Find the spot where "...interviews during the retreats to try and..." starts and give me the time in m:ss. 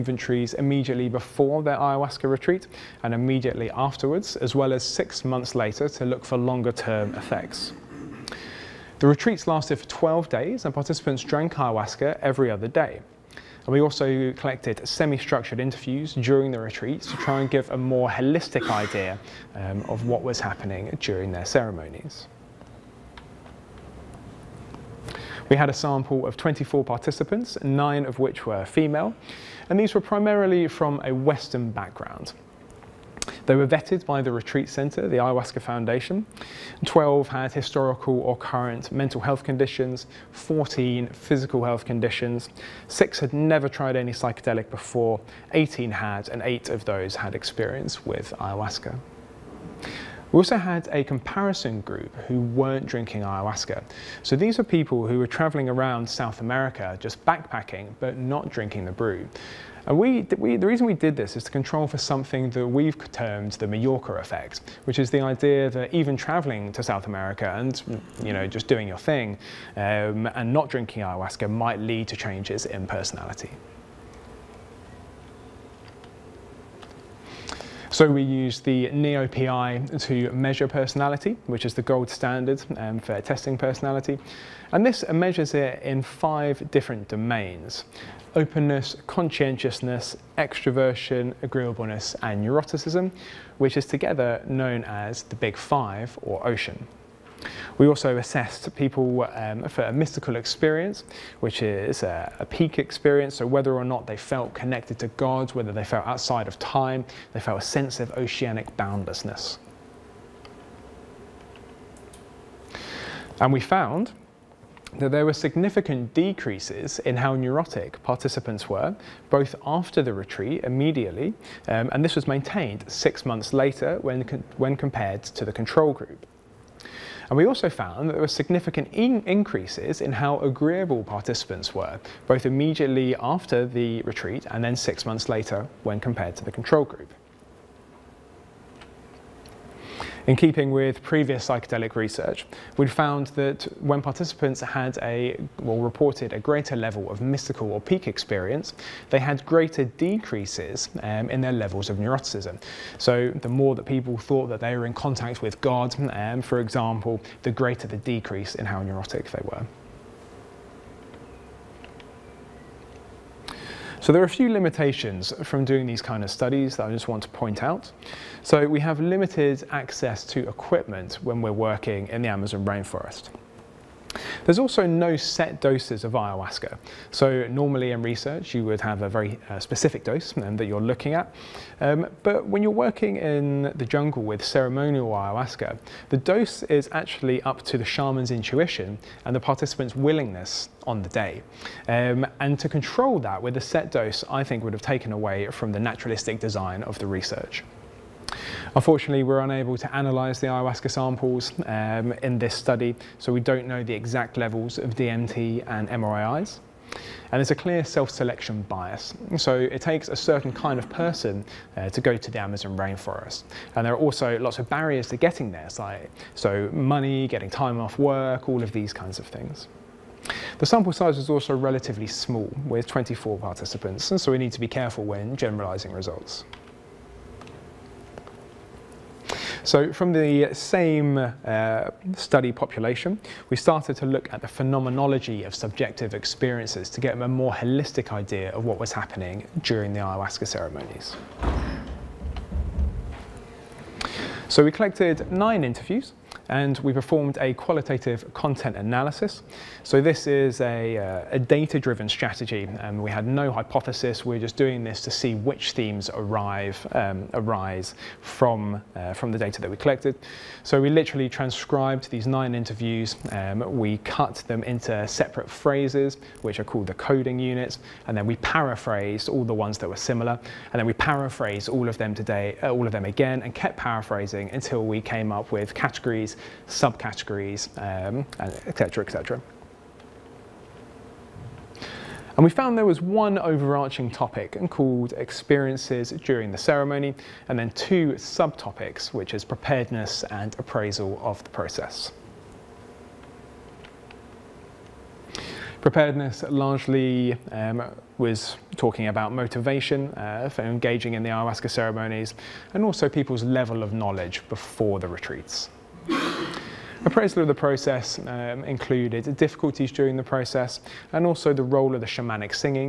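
0:15.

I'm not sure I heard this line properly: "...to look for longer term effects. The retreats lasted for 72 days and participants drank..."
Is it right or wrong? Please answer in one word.
wrong.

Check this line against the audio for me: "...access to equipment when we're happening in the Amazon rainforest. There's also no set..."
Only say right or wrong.
wrong.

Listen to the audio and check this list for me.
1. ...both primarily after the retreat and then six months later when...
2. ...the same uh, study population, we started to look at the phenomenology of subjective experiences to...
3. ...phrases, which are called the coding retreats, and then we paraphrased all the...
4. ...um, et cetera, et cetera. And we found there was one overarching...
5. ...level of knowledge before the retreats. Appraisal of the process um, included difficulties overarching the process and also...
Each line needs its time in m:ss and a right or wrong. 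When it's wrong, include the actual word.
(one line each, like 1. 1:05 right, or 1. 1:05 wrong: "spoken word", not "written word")
1. 2:12 wrong: "immediately", not "primarily"
2. 3:50 right
3. 4:25 wrong: "units", not "retreats"
4. 4:37 right
5. 5:03 wrong: "during", not "overarching".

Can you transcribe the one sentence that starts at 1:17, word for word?
So we use the NeoPI to measure personality, which is the gold standard um, for testing personality.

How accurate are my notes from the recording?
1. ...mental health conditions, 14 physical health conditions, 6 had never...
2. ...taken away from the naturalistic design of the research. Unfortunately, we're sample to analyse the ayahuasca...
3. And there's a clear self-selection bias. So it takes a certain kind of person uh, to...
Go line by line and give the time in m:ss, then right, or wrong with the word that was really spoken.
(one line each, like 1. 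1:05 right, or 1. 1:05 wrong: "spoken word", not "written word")
1. 0:38 right
2. 3:14 wrong: "unable", not "sample"
3. 3:26 right.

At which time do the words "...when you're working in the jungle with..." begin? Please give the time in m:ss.
3:02.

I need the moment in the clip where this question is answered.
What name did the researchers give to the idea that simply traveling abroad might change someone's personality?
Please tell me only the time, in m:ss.
1:03.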